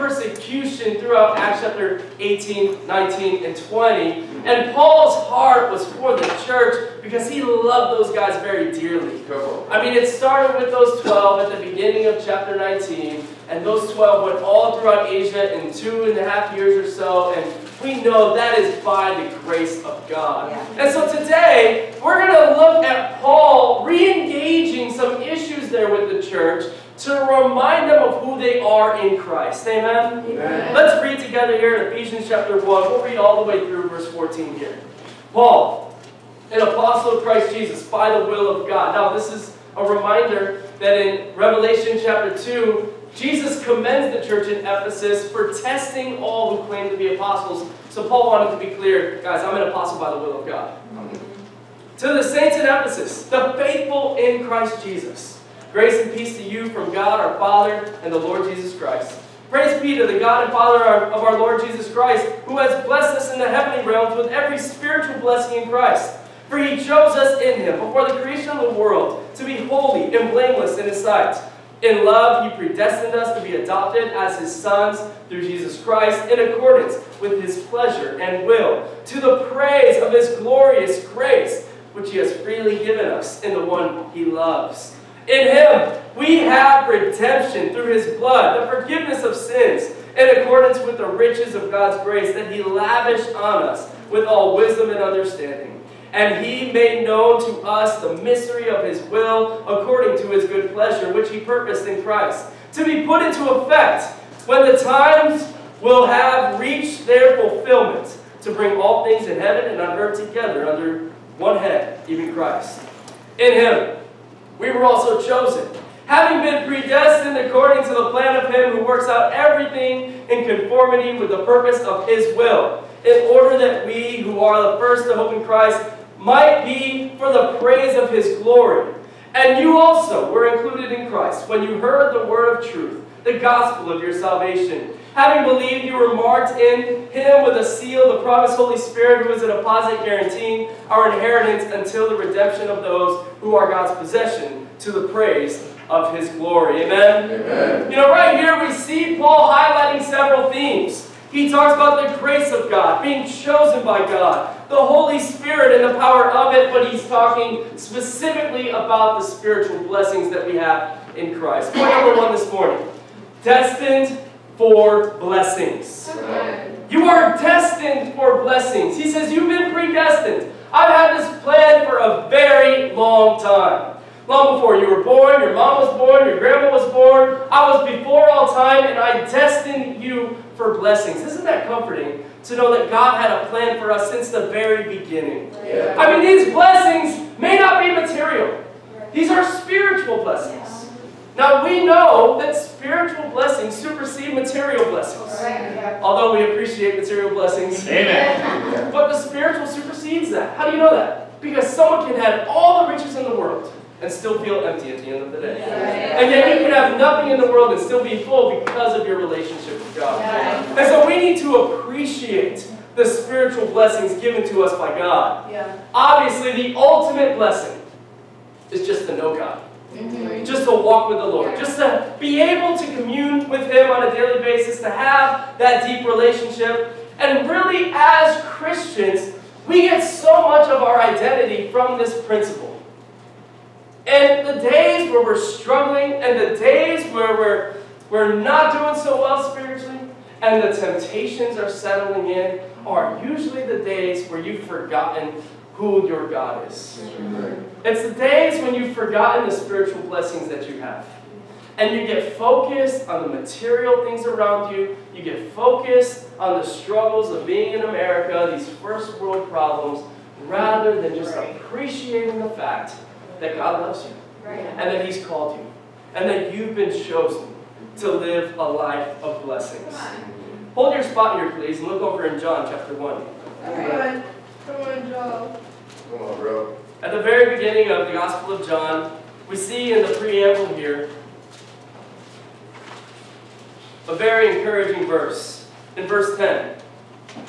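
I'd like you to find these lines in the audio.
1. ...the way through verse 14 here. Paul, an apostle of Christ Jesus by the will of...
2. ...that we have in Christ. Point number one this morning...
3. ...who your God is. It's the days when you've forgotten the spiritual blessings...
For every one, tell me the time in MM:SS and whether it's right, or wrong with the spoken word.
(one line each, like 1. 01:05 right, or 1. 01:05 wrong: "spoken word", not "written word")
1. 00:33 right
2. 02:40 right
3. 04:05 right.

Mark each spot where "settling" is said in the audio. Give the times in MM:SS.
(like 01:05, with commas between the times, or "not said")
04:01.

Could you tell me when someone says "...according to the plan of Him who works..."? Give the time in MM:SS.
01:57.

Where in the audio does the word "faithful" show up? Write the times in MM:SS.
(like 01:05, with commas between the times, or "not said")
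00:53.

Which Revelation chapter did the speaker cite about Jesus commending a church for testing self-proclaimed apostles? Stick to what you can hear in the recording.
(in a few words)
Chapter 2.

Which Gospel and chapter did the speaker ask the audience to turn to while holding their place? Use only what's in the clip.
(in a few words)
John chapter 1.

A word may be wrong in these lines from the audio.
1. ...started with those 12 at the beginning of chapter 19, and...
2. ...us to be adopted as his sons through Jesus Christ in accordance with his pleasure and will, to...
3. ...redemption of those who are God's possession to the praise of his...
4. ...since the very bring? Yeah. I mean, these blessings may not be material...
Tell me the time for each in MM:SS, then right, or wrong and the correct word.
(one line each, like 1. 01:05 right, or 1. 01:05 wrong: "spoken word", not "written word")
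1. 00:10 right
2. 01:13 right
3. 02:22 right
4. 03:04 wrong: "beginning", not "bring".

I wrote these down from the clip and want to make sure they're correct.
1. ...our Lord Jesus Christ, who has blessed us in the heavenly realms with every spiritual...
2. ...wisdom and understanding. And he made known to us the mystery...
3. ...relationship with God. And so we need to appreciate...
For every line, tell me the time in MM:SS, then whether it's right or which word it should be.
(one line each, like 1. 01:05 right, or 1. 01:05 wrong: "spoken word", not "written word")
1. 01:01 right
2. 01:34 right
3. 03:29 right.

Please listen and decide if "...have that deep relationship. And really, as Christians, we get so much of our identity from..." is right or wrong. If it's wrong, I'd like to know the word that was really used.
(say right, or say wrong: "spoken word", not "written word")
right.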